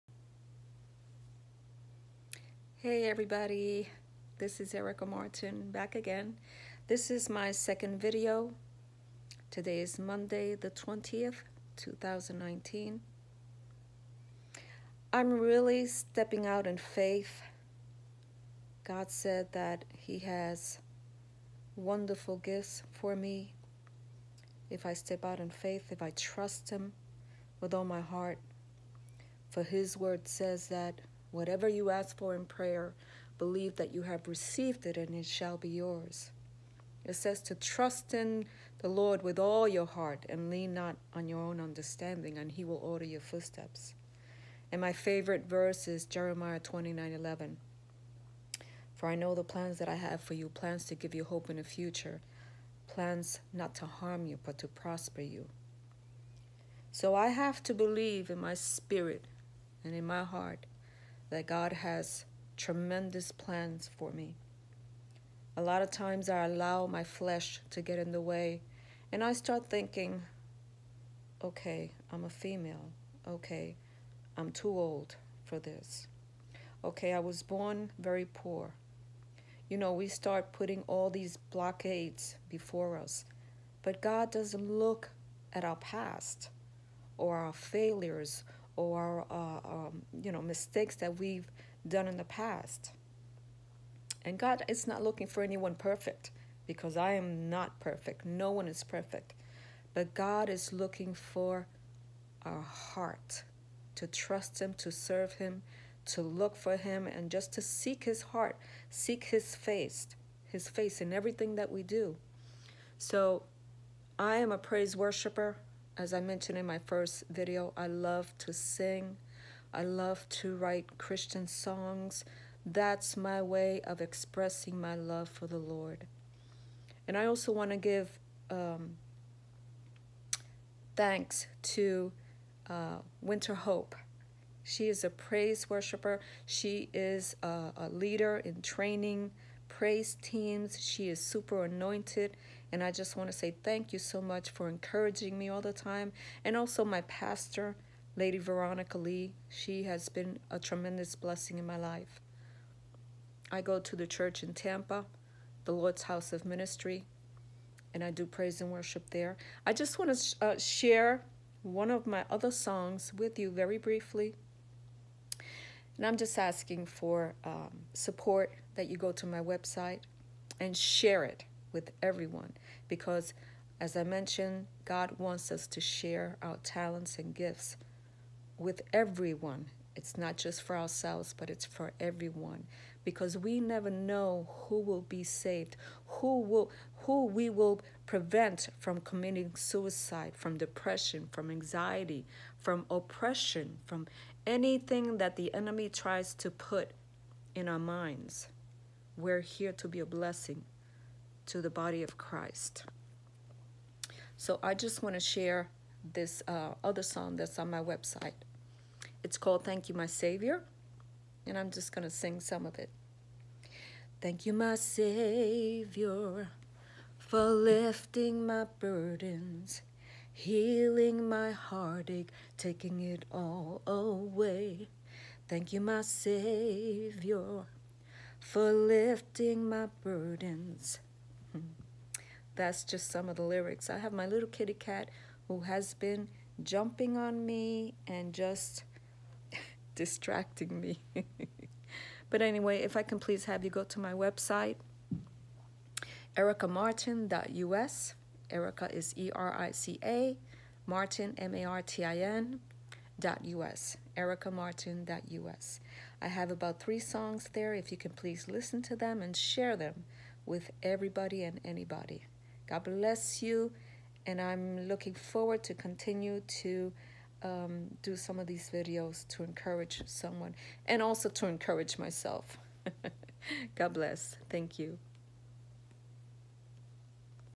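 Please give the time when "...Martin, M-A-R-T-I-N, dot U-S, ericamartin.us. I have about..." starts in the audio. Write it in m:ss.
4:10.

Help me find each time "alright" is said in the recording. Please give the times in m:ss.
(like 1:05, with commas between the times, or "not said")
not said.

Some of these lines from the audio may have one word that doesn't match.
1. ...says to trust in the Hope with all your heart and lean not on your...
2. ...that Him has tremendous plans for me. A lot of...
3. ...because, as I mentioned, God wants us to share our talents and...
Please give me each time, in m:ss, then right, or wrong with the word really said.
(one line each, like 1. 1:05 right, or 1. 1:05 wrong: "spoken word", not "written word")
1. 0:37 wrong: "Lord", not "Hope"
2. 1:01 wrong: "God", not "Him"
3. 2:52 right.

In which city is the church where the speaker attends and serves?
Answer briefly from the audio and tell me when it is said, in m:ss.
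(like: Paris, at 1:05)
Tampa, at 2:34.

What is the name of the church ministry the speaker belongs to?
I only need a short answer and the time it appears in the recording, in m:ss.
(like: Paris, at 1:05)
The Lord's House of Ministry, at 2:35.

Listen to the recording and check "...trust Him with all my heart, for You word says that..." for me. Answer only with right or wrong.
wrong.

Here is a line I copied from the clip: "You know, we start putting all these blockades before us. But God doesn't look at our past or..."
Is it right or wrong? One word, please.
right.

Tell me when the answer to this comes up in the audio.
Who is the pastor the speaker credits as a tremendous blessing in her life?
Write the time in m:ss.
2:28.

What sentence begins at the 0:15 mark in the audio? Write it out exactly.
I'm really stepping out in faith.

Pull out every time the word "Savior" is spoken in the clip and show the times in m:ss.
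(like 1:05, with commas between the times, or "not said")
3:30, 3:34, 3:46.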